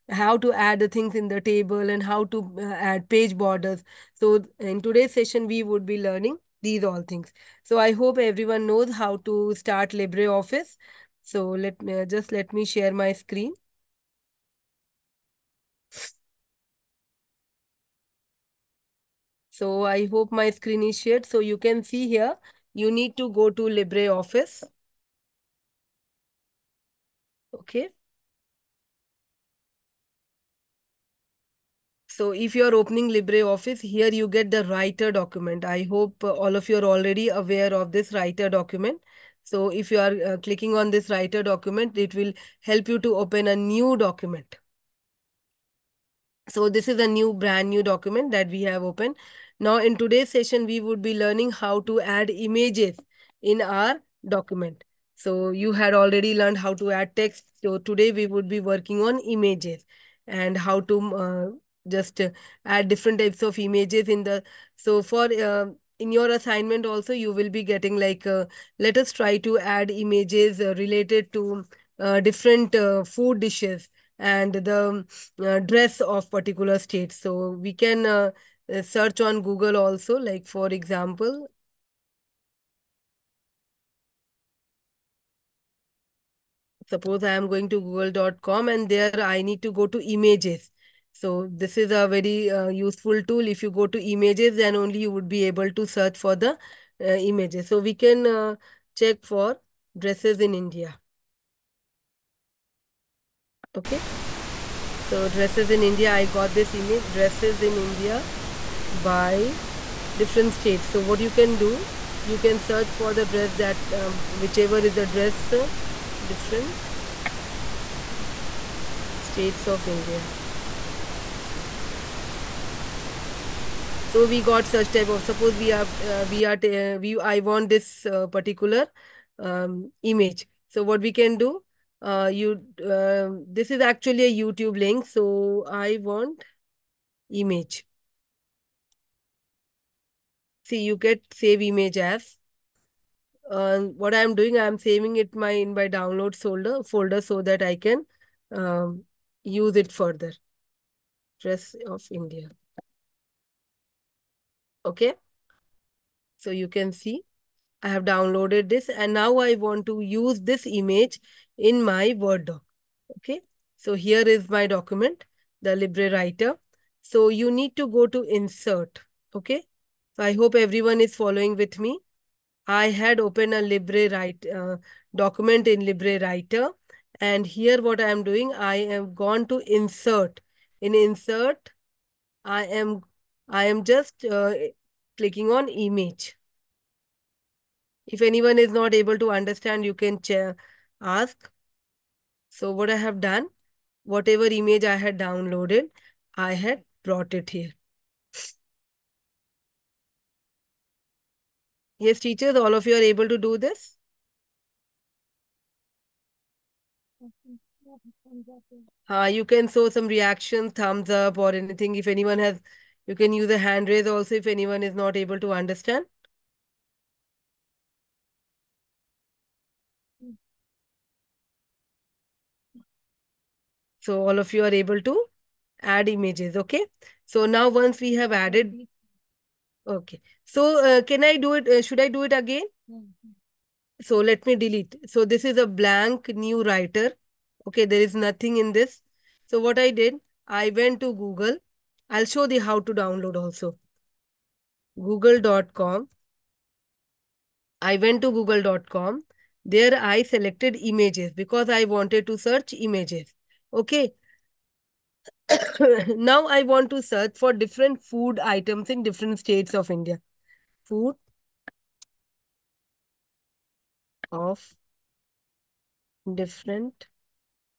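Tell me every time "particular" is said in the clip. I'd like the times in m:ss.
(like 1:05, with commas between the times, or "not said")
1:16, 2:08.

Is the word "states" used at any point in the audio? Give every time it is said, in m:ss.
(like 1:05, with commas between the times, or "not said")
1:16, 1:50, 1:59, 4:19.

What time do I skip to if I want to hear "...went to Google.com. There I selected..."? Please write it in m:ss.
4:08.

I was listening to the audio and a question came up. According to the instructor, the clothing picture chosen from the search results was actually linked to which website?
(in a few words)
YouTube.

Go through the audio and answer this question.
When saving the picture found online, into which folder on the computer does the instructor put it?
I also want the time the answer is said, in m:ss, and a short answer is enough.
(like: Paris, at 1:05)
Download folder, at 2:25.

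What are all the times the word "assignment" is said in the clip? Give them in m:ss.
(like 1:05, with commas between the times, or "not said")
1:06.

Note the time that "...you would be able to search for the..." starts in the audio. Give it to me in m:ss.
1:34.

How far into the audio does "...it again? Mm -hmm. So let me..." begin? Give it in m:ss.
3:52.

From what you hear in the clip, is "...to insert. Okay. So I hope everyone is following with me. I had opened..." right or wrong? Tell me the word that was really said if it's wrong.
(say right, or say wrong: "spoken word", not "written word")
right.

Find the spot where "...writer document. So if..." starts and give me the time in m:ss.
0:38.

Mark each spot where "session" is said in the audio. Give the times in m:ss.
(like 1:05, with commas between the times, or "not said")
0:05, 0:50.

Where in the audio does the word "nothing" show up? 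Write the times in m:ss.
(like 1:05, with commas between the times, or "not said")
3:58.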